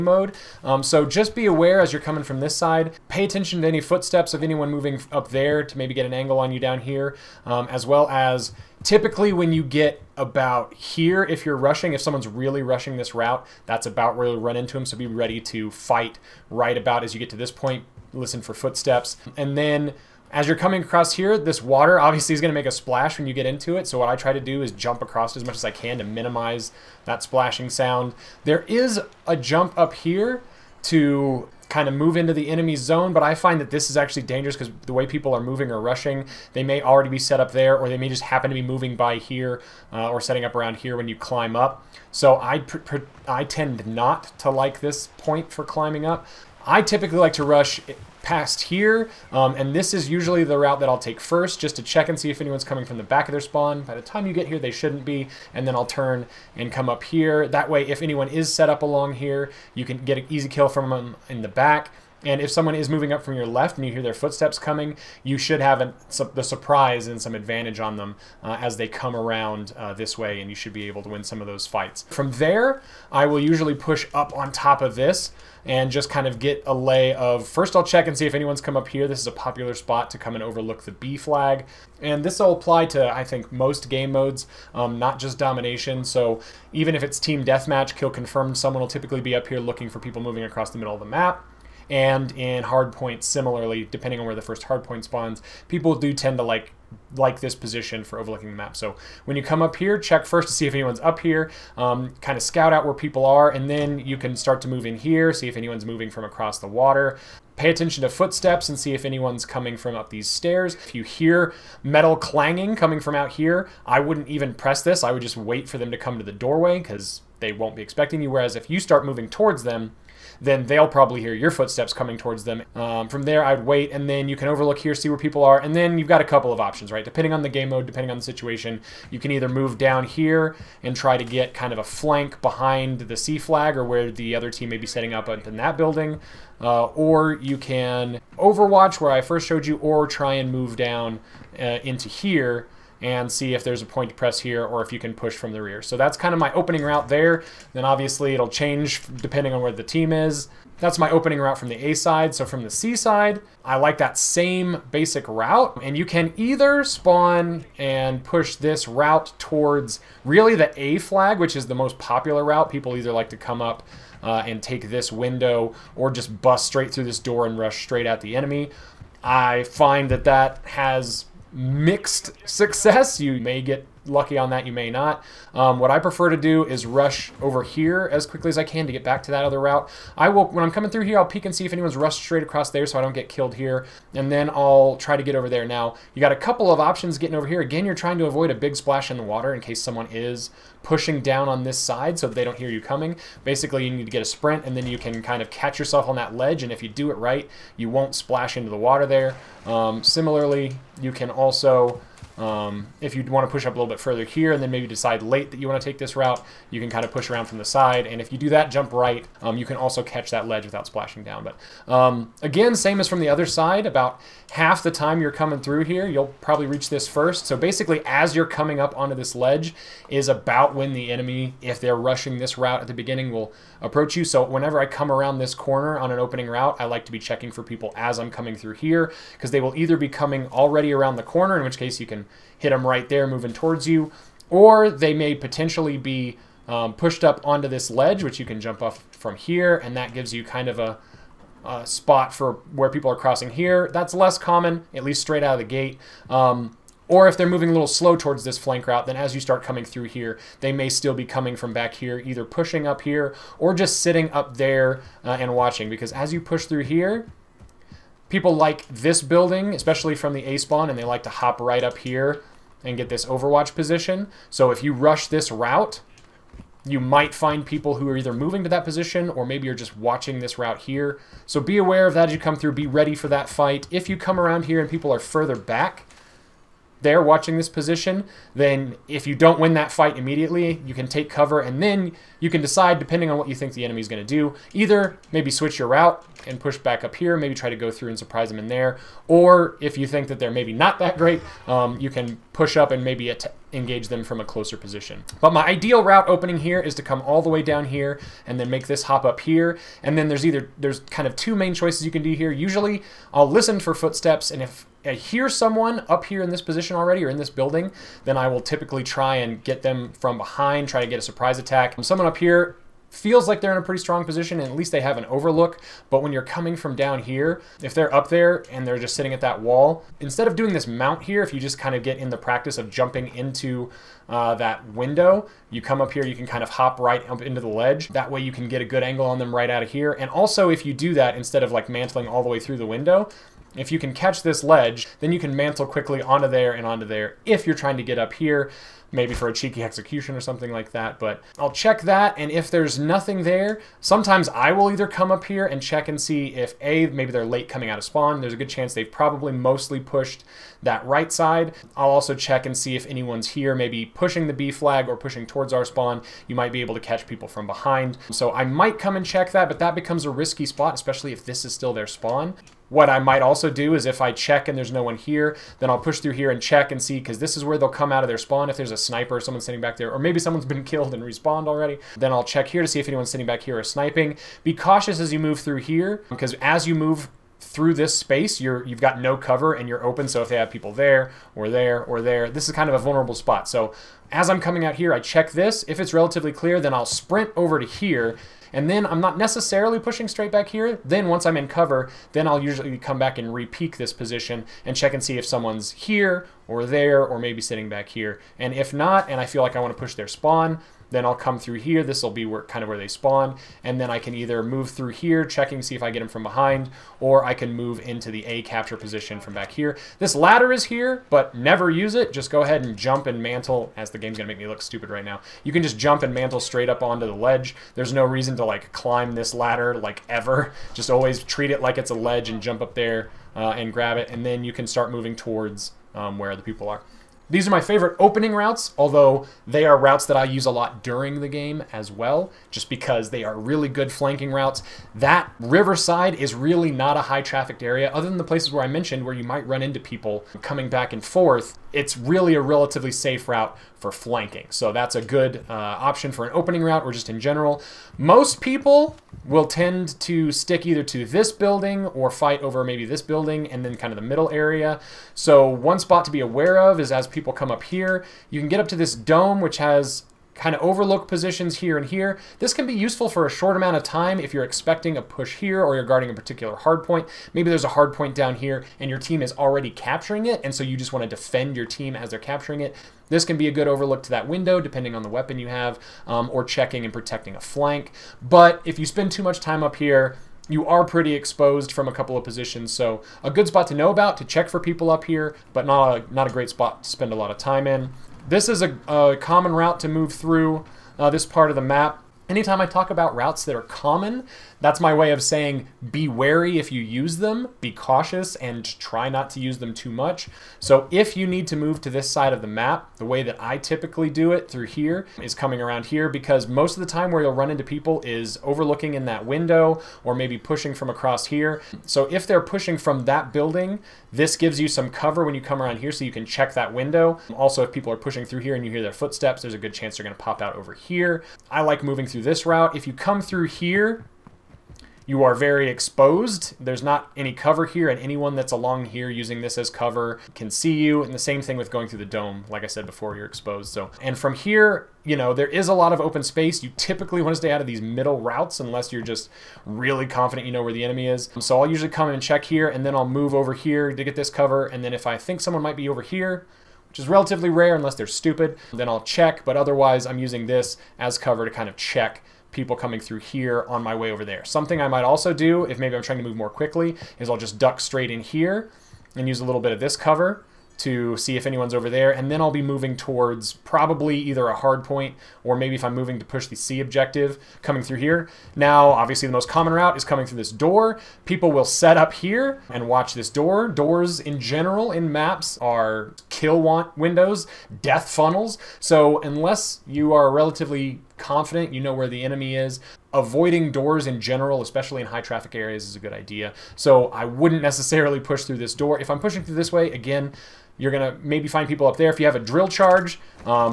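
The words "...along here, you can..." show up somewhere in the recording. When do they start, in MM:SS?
00:58.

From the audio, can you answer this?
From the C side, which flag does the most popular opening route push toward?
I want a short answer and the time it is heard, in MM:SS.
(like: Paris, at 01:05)
A flag, at 02:40.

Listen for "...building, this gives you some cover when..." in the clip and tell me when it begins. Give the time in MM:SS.
08:33.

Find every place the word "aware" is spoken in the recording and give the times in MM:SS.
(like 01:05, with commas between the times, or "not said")
00:01, 04:31, 07:36.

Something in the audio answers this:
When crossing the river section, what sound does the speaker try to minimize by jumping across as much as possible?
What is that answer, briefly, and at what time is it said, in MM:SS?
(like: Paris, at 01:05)
Splashing sound, at 00:27.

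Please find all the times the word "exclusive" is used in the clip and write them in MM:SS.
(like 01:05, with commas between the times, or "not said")
not said.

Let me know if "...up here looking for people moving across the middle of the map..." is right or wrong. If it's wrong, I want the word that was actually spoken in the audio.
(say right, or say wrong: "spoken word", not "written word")
right.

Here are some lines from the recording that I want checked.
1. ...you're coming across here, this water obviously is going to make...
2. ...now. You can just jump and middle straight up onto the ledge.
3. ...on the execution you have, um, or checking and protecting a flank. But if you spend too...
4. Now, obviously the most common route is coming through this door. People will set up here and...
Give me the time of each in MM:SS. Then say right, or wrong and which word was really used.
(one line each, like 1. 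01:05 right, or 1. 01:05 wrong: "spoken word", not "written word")
1. 00:20 right
2. 06:55 wrong: "mantle", not "middle"
3. 07:55 wrong: "weapon", not "execution"
4. 09:28 right.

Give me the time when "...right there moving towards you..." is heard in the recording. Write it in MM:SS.
03:52.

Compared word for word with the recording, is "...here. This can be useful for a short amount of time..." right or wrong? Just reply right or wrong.
right.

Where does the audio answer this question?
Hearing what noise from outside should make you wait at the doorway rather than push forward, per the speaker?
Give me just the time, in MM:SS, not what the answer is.
01:51.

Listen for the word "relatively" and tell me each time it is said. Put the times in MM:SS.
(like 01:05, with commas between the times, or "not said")
06:26, 07:22, 09:07, 09:40.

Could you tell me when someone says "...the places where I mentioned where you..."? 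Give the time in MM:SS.
07:18.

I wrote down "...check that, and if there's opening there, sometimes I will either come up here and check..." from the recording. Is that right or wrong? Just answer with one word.
wrong.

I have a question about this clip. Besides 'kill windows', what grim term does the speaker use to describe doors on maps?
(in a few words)
Death funnels.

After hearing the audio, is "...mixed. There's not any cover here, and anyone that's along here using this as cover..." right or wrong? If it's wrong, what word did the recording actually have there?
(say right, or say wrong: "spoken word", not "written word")
wrong: "exposed", not "mixed".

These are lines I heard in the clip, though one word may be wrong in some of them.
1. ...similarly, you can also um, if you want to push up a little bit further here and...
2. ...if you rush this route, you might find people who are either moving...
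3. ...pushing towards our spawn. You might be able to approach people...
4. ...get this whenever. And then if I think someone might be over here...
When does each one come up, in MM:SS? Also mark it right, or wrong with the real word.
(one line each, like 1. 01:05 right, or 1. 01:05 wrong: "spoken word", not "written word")
1. 03:20 right
2. 04:24 right
3. 05:55 wrong: "catch", not "approach"
4. 09:04 wrong: "cover", not "whenever".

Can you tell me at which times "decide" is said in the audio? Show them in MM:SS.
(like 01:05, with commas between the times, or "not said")
03:24, 04:42.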